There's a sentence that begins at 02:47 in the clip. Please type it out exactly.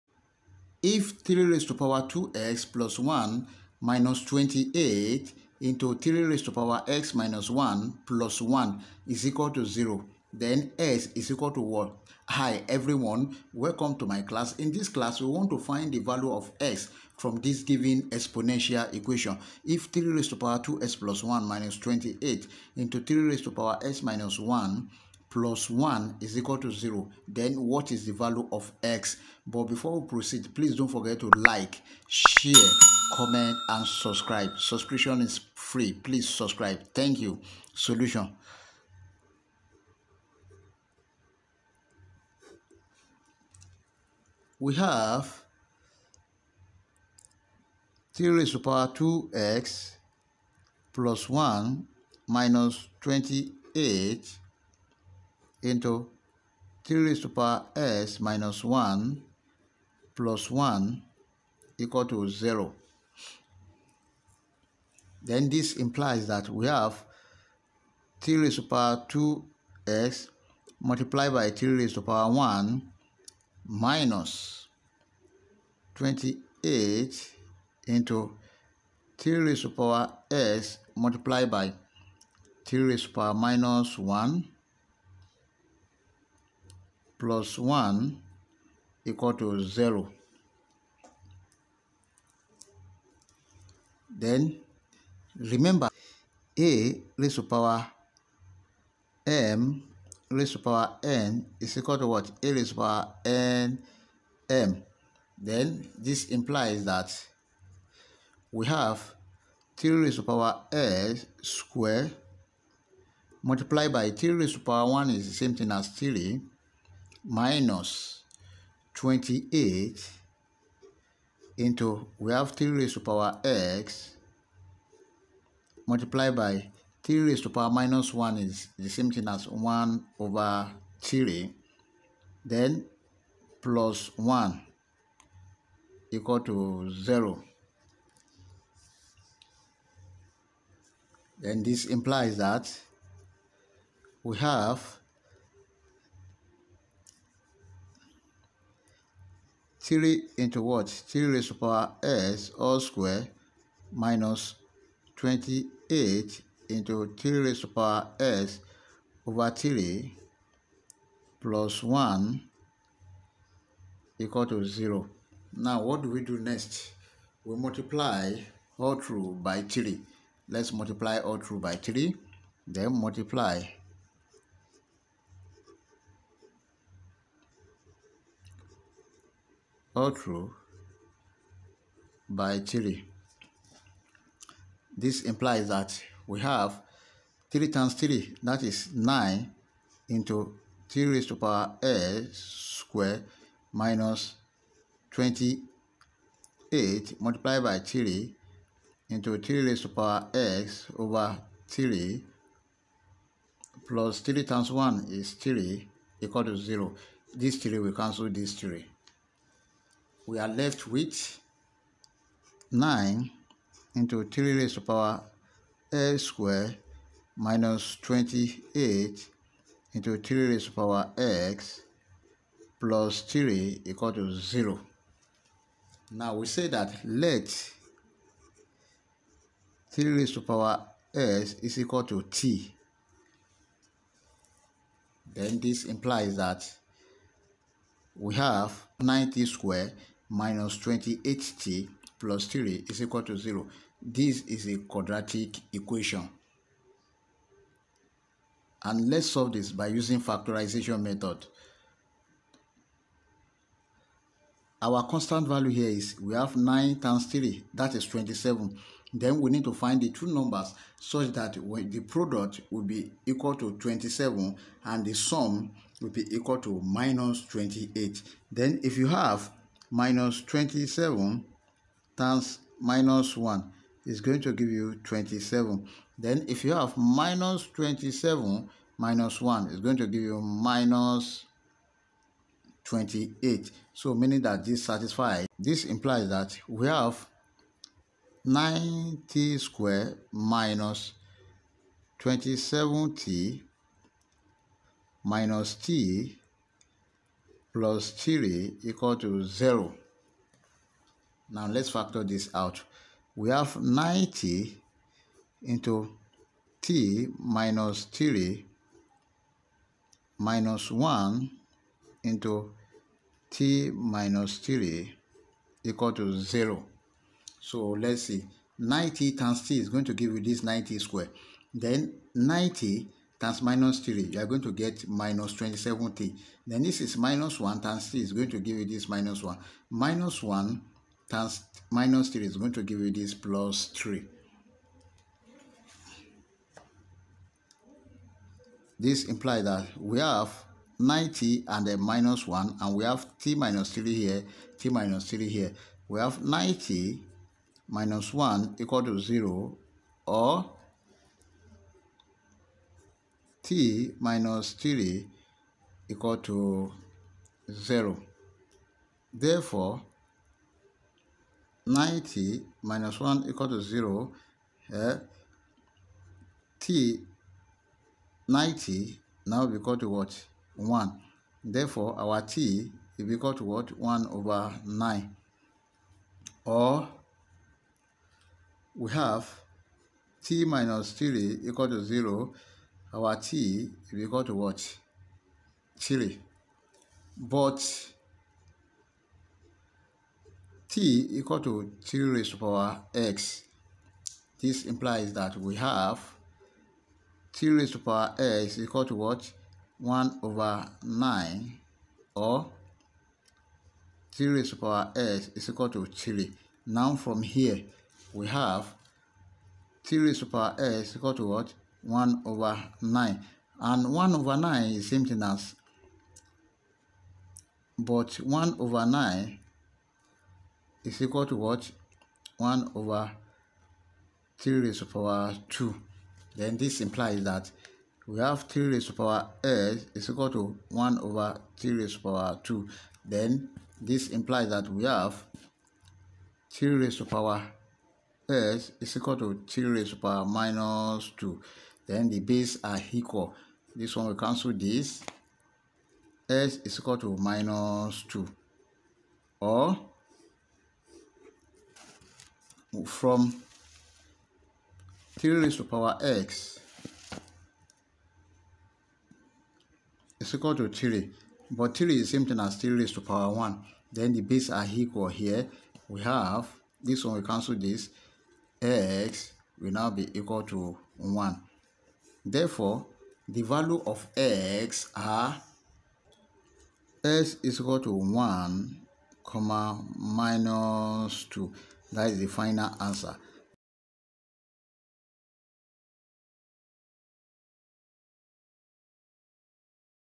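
We multiply all through by 3.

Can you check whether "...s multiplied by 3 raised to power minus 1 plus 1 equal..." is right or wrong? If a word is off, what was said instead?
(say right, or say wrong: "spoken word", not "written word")
right.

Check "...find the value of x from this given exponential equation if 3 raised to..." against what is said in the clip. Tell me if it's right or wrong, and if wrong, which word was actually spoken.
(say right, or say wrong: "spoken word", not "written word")
right.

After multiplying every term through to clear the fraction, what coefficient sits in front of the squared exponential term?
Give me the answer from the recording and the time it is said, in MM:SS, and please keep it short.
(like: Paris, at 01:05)
9, at 03:08.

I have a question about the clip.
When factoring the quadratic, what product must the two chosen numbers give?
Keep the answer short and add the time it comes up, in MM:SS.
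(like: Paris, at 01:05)
27, at 04:21.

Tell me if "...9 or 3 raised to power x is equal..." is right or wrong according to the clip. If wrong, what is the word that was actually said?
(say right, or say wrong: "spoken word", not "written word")
right.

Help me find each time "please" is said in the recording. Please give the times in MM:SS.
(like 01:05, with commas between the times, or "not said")
00:30, 00:35.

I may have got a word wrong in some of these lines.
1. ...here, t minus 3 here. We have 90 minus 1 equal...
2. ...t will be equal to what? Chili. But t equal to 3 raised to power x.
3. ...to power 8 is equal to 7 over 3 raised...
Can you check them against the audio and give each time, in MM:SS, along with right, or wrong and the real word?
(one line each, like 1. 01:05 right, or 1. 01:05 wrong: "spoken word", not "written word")
1. 05:44 right
2. 06:23 right
3. 07:09 wrong: "1", not "7".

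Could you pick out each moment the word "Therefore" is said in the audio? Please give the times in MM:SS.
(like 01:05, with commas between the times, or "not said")
05:59, 06:11, 07:52.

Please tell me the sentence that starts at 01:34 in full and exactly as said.
Then remember a raised to power m raised to power n is equal to what?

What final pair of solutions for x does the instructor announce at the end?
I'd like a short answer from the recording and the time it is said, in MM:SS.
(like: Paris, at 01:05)
1 and -2, at 07:57.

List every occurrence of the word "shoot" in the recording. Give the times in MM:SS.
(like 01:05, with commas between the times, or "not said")
not said.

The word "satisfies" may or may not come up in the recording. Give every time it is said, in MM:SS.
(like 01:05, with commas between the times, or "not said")
04:44.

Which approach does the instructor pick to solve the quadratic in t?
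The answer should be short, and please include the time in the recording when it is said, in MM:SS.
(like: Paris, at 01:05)
Factorization method, at 04:10.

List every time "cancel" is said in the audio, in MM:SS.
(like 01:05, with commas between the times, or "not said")
03:27, 07:24, 07:47.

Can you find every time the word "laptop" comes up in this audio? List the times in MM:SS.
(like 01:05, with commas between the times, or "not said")
not said.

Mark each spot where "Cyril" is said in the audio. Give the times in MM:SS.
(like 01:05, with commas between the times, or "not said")
not said.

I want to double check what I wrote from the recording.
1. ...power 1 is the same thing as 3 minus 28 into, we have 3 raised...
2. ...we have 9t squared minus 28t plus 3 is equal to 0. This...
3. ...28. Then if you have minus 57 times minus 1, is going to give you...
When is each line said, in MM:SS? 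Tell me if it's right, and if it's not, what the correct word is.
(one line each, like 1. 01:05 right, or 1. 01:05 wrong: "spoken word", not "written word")
1. 01:54 right
2. 03:58 right
3. 04:27 wrong: "27", not "57".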